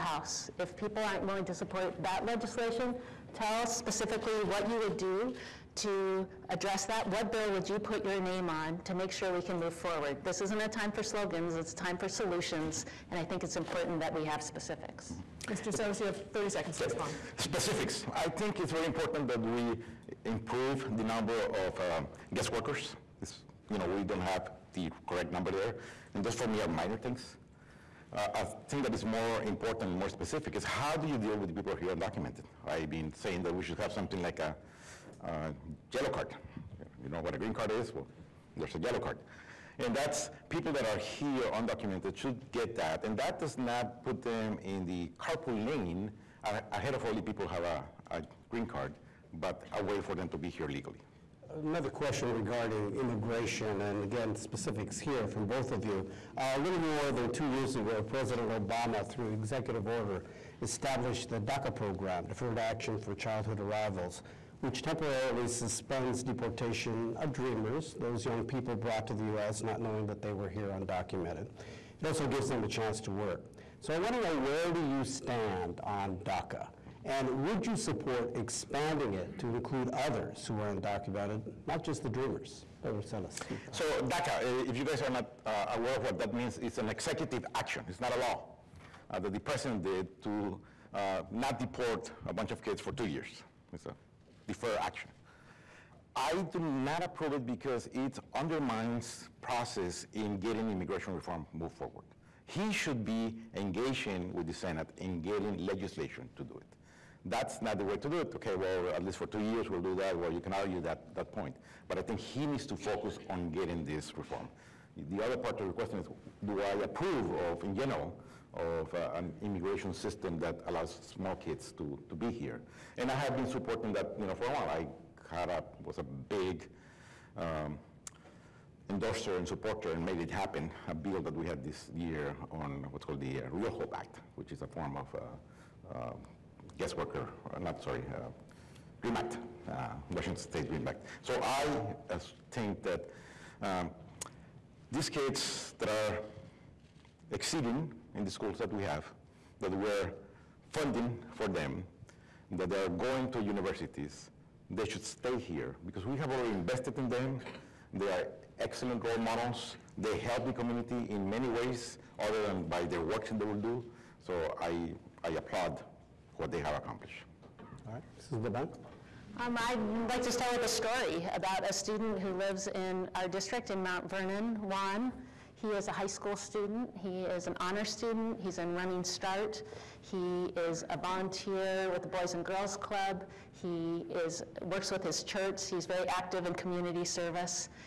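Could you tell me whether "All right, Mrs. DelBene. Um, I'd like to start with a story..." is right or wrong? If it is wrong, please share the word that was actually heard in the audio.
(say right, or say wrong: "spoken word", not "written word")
right.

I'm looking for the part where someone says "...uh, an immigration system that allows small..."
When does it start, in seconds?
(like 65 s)
118 s.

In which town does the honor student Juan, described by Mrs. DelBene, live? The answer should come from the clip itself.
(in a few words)
Mount Vernon.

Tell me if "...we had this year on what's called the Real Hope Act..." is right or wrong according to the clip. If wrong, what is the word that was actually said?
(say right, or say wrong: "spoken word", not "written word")
right.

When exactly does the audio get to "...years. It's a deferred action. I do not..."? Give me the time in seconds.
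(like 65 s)
93 s.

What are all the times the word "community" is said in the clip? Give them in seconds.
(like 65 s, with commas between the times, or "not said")
160 s, 186 s.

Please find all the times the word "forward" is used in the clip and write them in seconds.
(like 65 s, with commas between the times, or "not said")
9 s, 101 s.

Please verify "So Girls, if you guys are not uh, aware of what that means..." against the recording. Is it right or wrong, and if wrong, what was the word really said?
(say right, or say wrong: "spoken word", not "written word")
wrong: "DACA", not "Girls".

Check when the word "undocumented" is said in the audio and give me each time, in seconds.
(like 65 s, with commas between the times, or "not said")
31 s, 41 s, 70 s, 80 s.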